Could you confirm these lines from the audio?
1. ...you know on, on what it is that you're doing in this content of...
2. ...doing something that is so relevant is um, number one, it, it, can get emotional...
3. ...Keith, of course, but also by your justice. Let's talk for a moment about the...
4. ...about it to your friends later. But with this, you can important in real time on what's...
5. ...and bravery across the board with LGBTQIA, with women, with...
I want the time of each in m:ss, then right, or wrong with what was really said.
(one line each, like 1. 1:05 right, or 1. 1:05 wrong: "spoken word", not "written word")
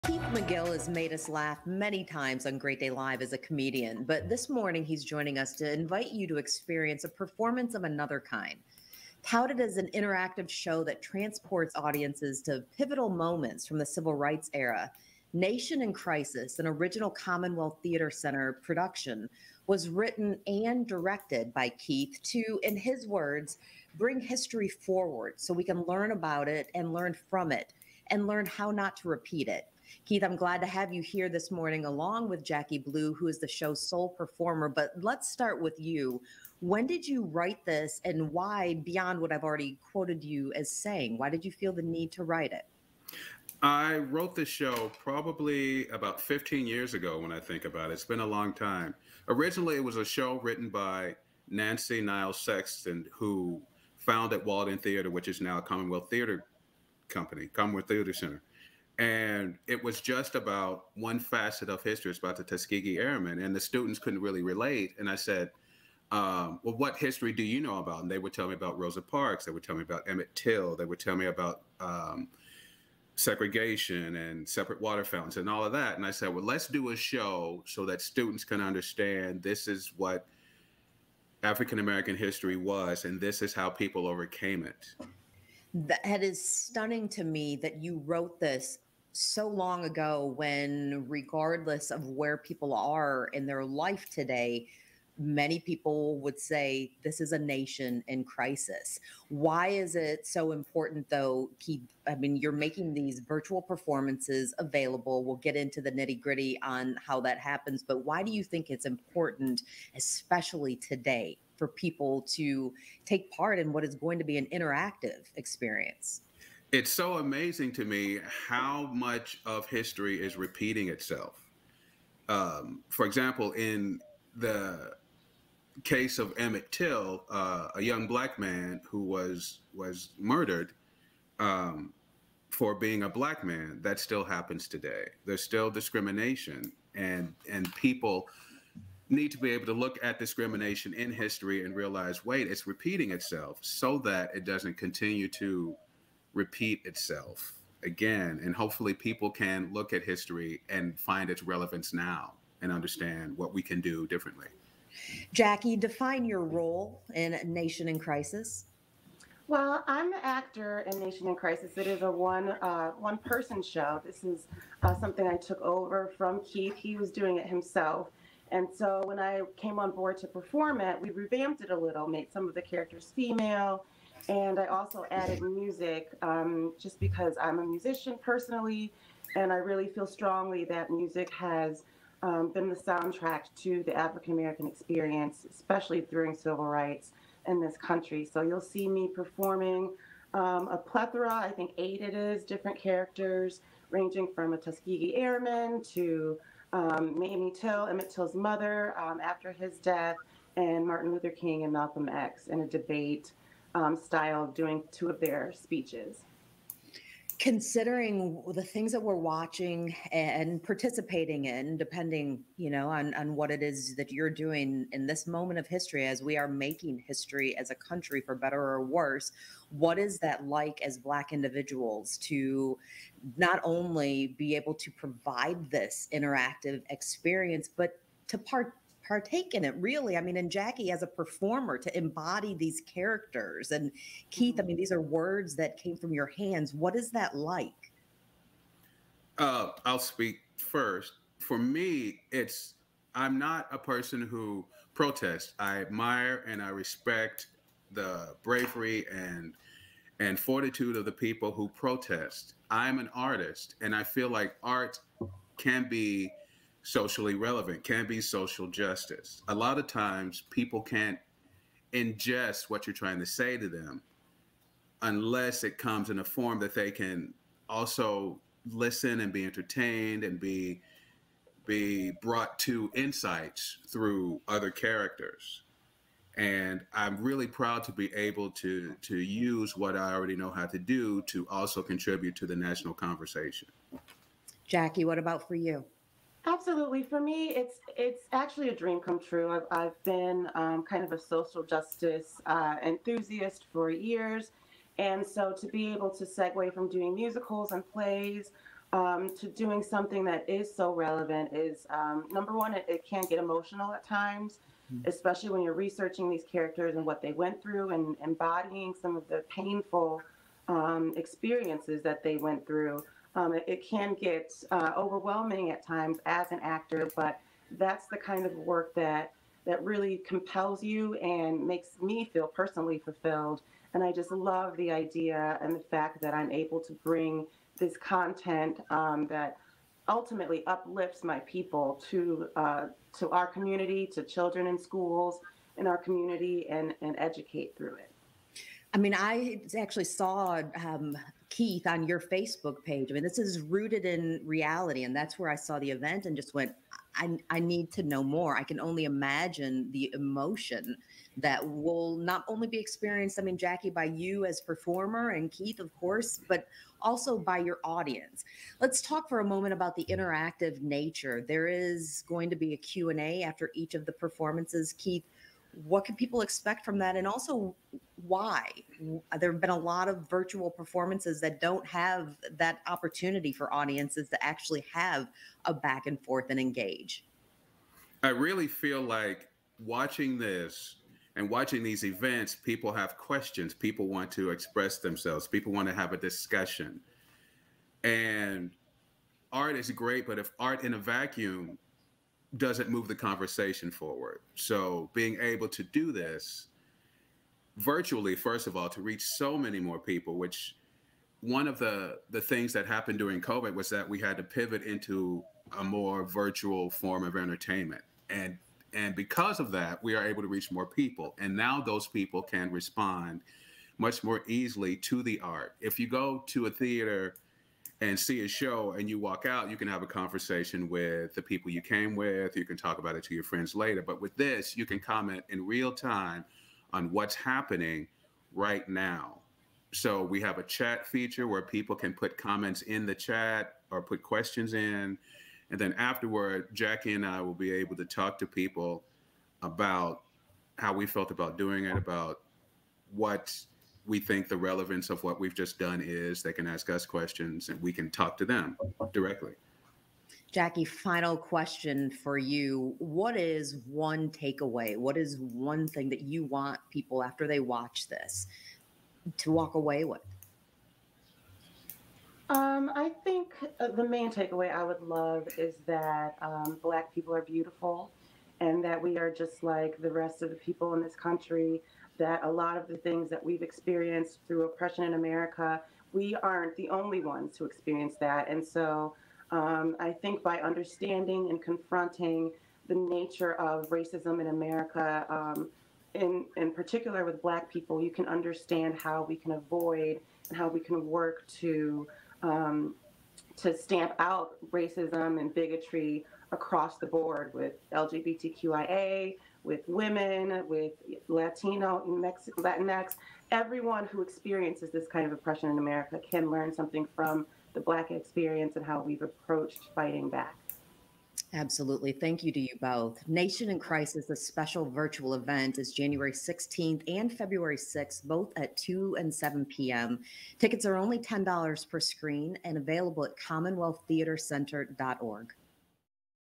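1. 3:32 wrong: "moment", not "content"
2. 4:59 right
3. 5:55 wrong: "audience", not "justice"
4. 7:02 wrong: "comment", not "important"
5. 8:15 wrong: "bigotry", not "bravery".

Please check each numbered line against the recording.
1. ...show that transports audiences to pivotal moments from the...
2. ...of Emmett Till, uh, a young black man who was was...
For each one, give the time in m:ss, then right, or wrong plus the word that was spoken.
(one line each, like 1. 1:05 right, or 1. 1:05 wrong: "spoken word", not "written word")
1. 0:10 right
2. 2:06 right.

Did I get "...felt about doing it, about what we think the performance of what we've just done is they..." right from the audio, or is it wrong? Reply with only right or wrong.
wrong.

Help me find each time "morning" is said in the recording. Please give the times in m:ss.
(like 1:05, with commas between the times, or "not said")
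0:04, 0:31.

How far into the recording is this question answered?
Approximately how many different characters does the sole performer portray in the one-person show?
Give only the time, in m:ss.
3:11.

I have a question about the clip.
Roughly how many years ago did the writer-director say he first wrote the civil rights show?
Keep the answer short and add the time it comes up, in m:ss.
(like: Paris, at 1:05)
15, at 0:46.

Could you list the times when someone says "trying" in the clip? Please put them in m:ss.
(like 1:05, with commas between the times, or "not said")
4:22.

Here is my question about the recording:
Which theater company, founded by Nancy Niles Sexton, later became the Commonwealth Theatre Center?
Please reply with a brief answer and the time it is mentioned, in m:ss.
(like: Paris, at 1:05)
Walden Theater, at 0:54.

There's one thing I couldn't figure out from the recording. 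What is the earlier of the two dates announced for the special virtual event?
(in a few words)
January 16th.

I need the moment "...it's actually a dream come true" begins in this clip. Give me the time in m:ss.
4:47.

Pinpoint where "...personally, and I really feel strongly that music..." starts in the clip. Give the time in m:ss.
2:58.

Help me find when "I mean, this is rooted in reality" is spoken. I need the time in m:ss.
5:43.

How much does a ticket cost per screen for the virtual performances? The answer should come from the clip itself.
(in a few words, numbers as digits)
$10.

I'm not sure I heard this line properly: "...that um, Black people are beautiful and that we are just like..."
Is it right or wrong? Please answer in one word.
right.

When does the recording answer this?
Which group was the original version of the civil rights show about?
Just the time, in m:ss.
1:02.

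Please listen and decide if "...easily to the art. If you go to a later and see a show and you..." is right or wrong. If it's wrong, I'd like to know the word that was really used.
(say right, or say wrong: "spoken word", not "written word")
wrong: "theater", not "later".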